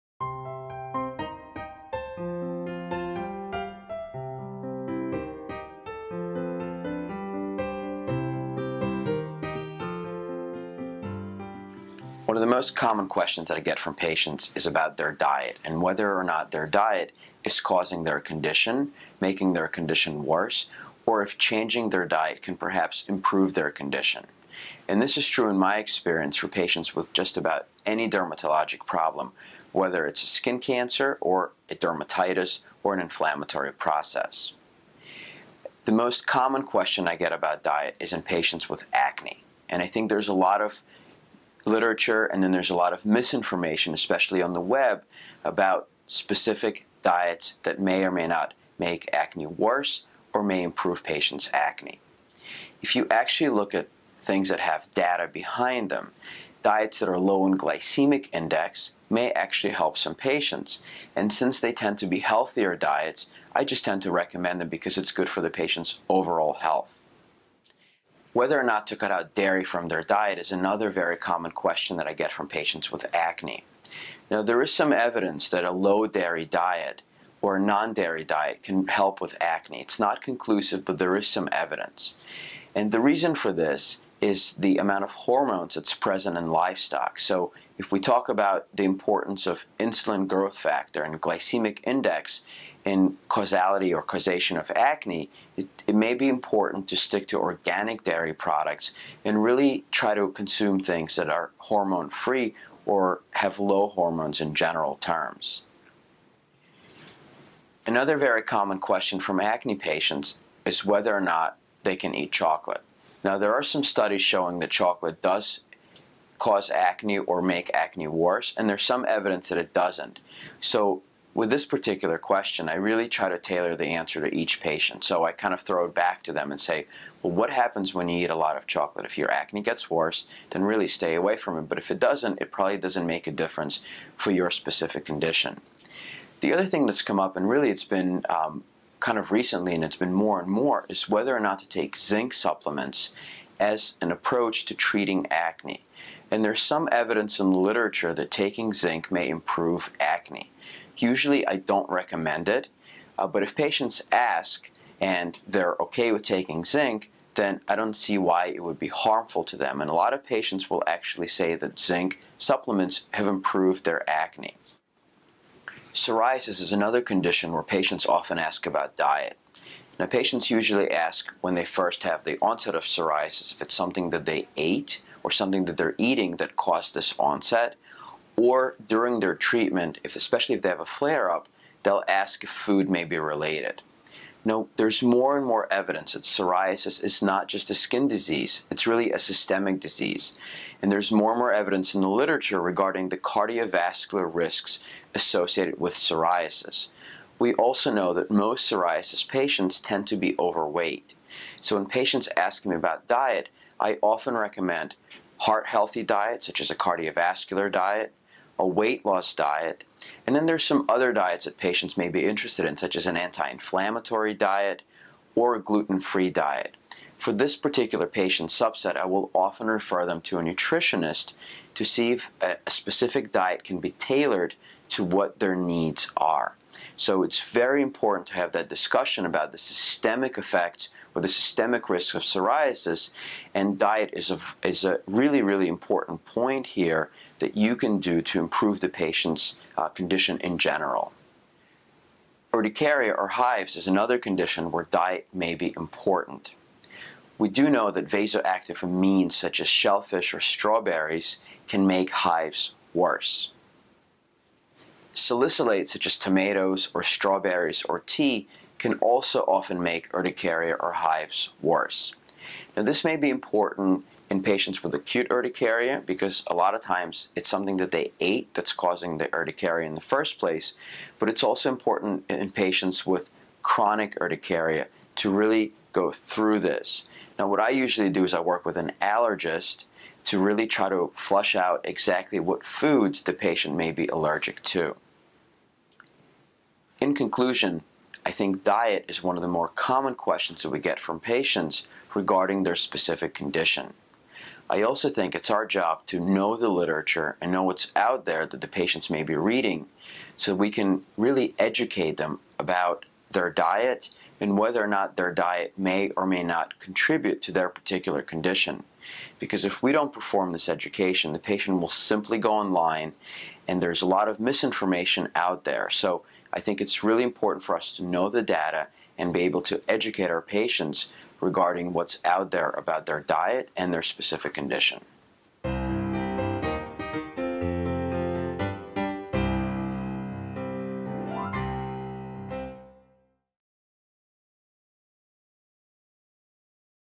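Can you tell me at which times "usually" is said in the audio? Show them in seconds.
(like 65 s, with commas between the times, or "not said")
150 s, 170 s, 277 s.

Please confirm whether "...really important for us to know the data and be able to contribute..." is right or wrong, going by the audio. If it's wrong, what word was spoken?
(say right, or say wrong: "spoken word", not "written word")
wrong: "educate", not "contribute".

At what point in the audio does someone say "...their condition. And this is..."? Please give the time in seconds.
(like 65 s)
23 s.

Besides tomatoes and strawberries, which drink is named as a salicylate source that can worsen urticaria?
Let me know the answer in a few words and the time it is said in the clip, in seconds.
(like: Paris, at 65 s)
tea, at 258 s.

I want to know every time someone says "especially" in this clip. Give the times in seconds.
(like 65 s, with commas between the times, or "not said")
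43 s, 180 s.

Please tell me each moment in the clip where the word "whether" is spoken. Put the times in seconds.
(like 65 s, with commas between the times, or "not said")
15 s, 29 s, 68 s, 110 s, 141 s, 304 s.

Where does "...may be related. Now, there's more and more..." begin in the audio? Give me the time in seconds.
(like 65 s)
182 s.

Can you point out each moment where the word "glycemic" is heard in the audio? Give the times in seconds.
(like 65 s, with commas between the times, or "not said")
57 s, 91 s.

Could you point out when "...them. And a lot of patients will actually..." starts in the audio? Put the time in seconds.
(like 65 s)
159 s.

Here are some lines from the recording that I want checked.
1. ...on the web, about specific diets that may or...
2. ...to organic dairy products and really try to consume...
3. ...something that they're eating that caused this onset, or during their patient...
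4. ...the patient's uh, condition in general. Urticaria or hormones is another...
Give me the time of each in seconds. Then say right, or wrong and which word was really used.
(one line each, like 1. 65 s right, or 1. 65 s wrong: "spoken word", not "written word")
1. 44 s right
2. 97 s right
3. 175 s wrong: "treatment", not "patient"
4. 238 s wrong: "hives", not "hormones".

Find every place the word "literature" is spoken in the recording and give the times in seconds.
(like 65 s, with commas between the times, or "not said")
41 s, 147 s, 192 s, 296 s.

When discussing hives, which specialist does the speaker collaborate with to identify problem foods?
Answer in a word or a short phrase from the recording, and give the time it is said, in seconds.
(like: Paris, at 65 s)
an allergist, at 278 s.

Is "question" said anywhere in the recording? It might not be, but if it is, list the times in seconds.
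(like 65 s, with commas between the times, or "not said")
13 s, 36 s, 71 s, 108 s, 122 s, 290 s.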